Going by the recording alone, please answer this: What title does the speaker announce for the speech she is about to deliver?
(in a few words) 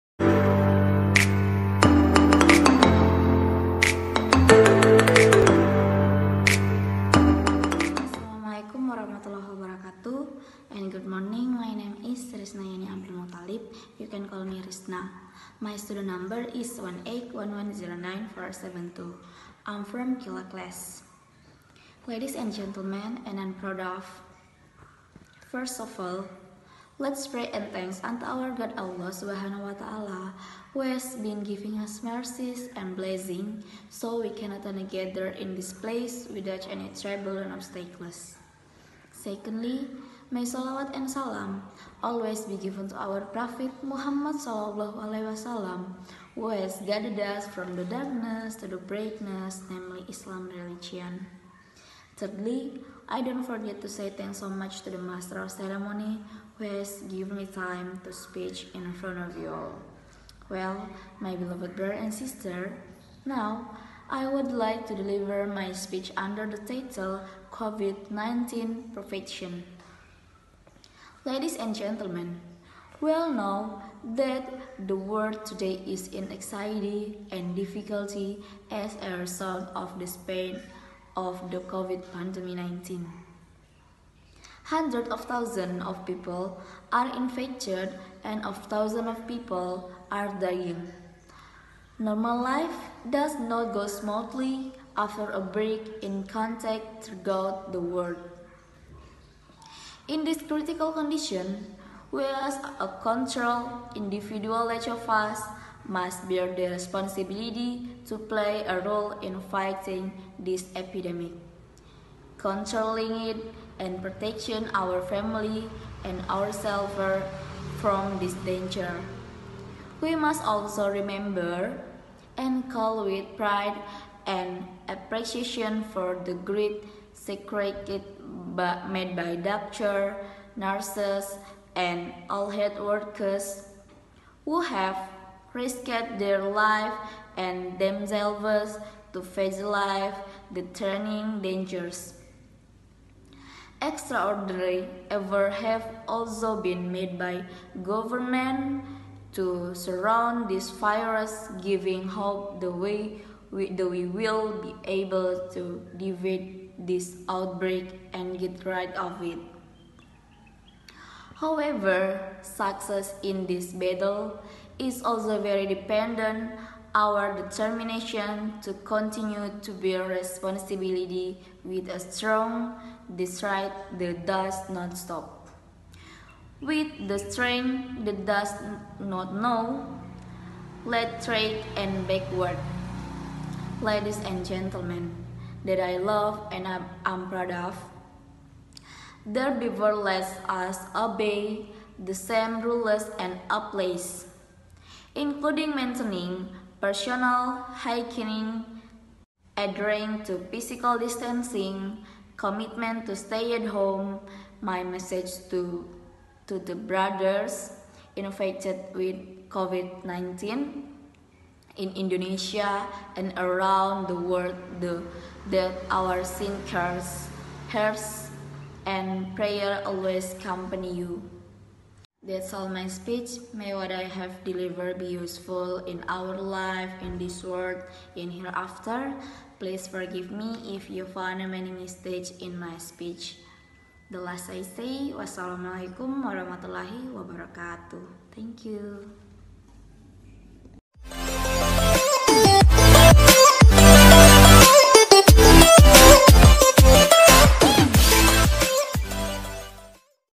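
COVID-19 Prevention.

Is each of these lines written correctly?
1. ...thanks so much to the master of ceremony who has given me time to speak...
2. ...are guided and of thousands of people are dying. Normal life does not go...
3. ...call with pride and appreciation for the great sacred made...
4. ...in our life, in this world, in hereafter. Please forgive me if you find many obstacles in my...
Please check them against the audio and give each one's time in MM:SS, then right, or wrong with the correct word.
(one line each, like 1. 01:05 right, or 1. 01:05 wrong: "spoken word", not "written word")
1. 00:54 right
2. 01:26 wrong: "infected", not "guided"
3. 02:02 right
4. 03:45 wrong: "mistakes", not "obstacles".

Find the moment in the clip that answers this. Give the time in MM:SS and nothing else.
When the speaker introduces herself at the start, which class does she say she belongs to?
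00:20.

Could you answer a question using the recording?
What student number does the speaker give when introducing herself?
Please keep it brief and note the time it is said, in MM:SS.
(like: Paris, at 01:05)
181109472, at 00:16.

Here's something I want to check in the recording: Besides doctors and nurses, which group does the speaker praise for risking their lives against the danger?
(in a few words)
health workers.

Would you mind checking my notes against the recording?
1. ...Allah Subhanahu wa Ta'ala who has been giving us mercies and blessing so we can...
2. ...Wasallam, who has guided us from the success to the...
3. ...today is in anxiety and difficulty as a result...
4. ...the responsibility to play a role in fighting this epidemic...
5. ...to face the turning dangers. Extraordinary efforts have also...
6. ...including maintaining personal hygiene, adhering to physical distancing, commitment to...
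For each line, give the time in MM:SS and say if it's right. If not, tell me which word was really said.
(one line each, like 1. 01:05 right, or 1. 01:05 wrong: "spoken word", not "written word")
1. 00:28 right
2. 00:45 wrong: "darkness", not "success"
3. 01:15 right
4. 01:46 right
5. 02:19 right
6. 03:15 right.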